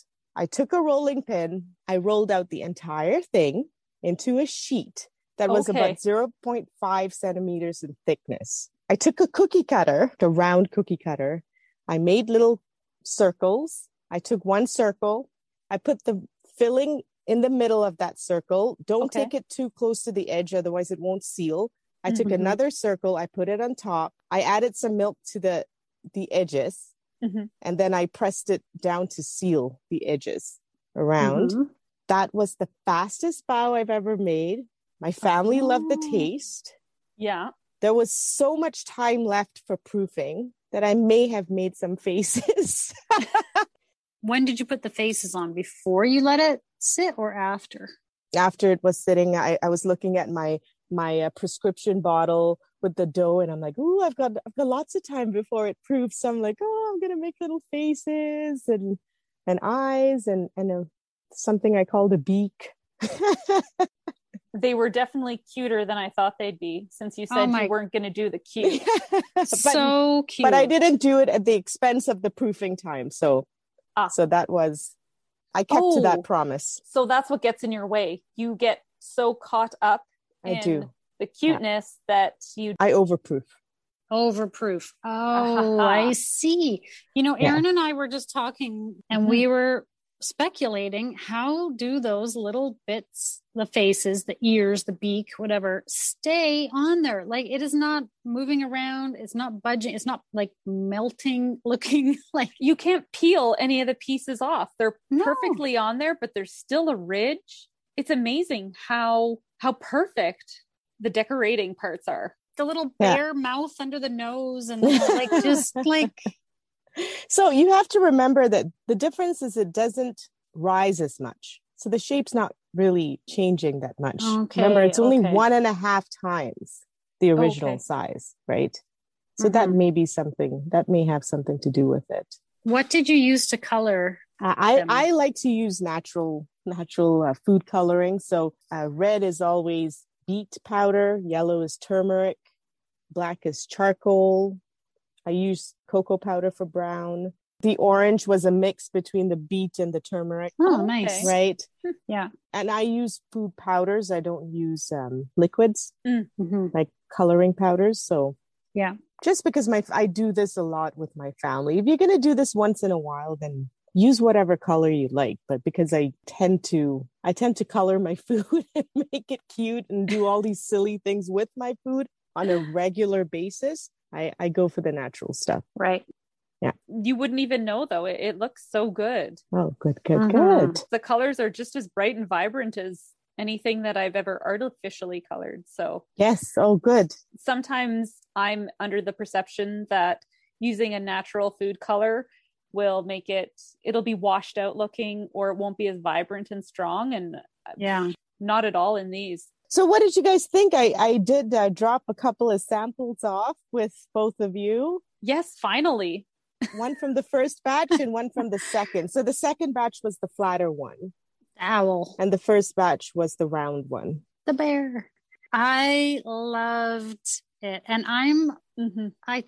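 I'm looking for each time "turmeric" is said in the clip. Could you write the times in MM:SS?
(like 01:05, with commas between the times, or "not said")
02:21, 02:29.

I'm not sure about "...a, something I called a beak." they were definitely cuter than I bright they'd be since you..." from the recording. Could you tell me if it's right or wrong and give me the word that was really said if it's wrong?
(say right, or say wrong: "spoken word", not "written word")
wrong: "thought", not "bright".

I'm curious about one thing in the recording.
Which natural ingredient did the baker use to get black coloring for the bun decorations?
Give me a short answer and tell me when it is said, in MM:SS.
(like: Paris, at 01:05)
charcoal, at 02:23.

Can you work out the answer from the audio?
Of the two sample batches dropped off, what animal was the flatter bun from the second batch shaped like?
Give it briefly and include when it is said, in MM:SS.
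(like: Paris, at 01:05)
owl, at 03:31.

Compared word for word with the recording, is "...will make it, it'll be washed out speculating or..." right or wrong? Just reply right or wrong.
wrong.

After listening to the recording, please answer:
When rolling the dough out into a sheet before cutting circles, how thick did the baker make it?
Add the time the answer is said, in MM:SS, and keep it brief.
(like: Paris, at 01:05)
0.5 centimeters, at 00:05.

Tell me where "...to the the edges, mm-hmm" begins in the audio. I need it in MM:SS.
00:25.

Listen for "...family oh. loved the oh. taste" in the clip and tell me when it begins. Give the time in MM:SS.
00:35.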